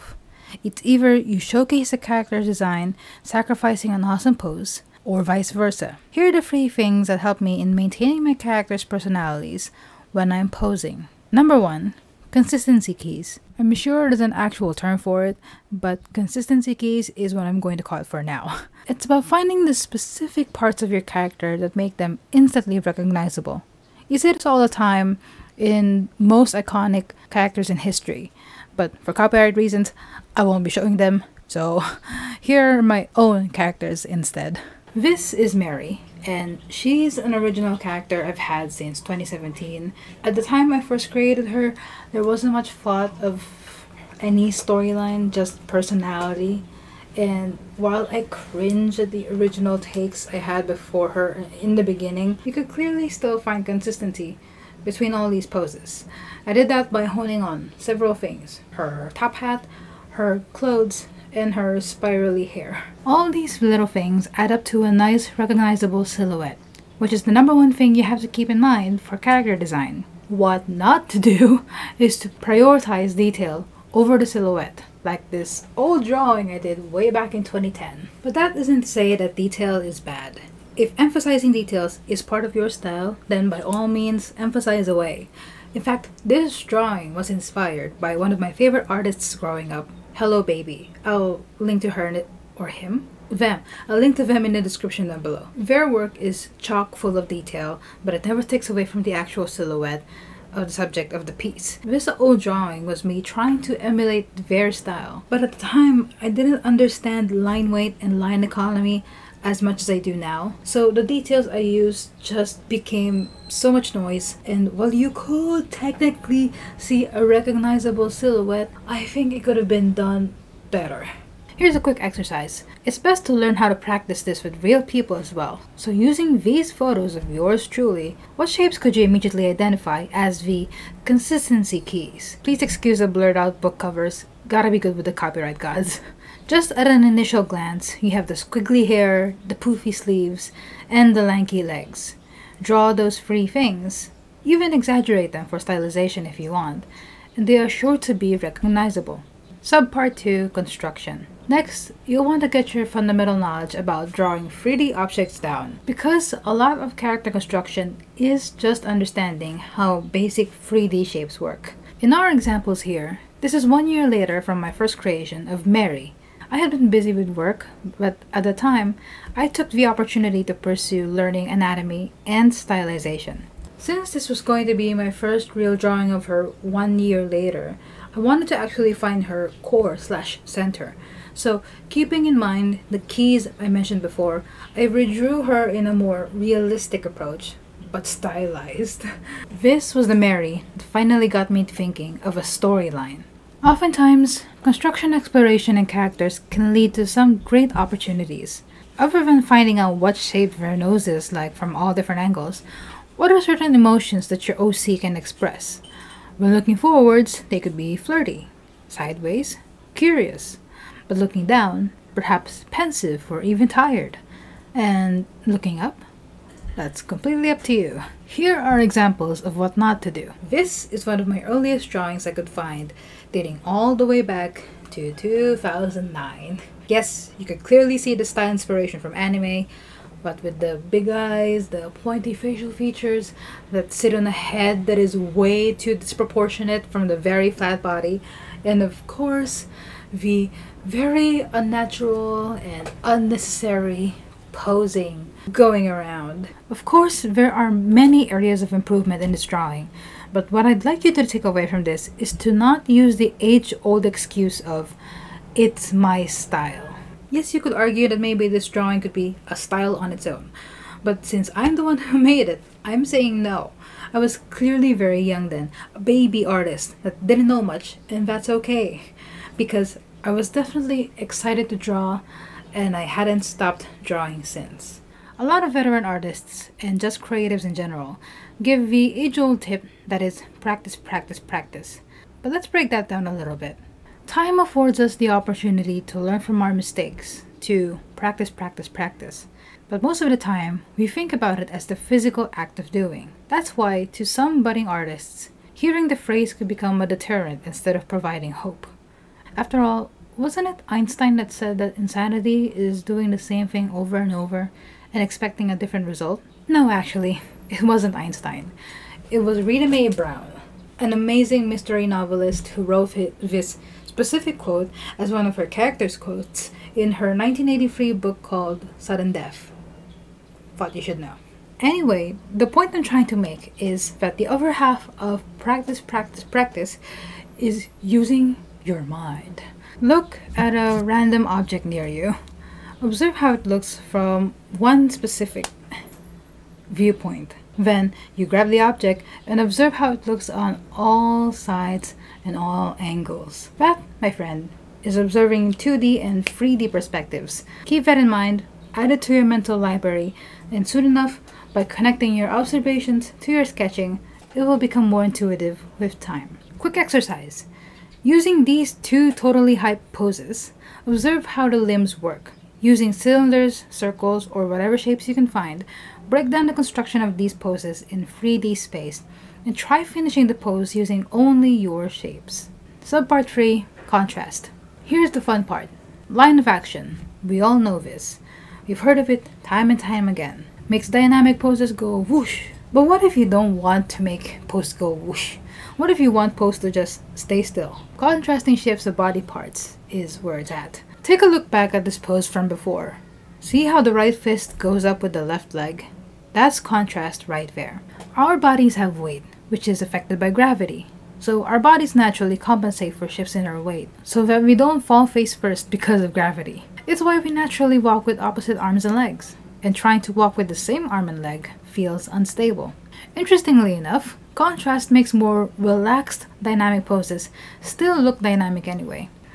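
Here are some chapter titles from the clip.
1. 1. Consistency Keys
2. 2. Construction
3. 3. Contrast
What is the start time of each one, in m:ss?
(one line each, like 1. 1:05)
1. 0:10
2. 2:28
3. 6:12.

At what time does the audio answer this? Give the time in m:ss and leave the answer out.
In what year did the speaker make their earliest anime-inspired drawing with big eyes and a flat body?
3:45.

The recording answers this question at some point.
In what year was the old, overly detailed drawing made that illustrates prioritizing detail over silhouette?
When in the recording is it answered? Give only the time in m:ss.
1:17.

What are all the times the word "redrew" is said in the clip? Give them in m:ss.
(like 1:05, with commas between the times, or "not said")
3:04.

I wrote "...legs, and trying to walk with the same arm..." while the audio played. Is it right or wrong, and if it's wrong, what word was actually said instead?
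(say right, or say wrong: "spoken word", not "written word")
right.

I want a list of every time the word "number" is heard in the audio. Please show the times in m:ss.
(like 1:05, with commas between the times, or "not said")
0:11, 1:07.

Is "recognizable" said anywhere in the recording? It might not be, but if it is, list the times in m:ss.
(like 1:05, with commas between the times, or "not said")
0:22, 1:05, 1:57, 2:28.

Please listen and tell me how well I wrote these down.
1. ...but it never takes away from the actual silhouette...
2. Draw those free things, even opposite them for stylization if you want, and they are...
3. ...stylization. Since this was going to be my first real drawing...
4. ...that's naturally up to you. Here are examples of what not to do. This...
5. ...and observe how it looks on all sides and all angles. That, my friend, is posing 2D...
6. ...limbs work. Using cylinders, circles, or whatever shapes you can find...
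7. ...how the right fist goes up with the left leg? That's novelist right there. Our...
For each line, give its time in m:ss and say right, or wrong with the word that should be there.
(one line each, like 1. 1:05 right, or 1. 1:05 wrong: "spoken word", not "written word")
1. 1:38 right
2. 2:22 wrong: "exaggerate", not "opposite"
3. 2:52 right
4. 3:36 wrong: "completely", not "naturally"
5. 5:39 wrong: "observing", not "posing"
6. 6:01 right
7. 6:33 wrong: "contrast", not "novelist".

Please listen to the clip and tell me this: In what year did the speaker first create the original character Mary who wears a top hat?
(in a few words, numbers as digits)
2017.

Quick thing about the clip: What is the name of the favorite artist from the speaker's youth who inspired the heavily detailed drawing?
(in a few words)
Hello Baby.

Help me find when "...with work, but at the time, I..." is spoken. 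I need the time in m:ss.
2:47.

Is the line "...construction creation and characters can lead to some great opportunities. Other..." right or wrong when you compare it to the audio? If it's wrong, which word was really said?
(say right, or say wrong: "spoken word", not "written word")
wrong: "exploration", not "creation".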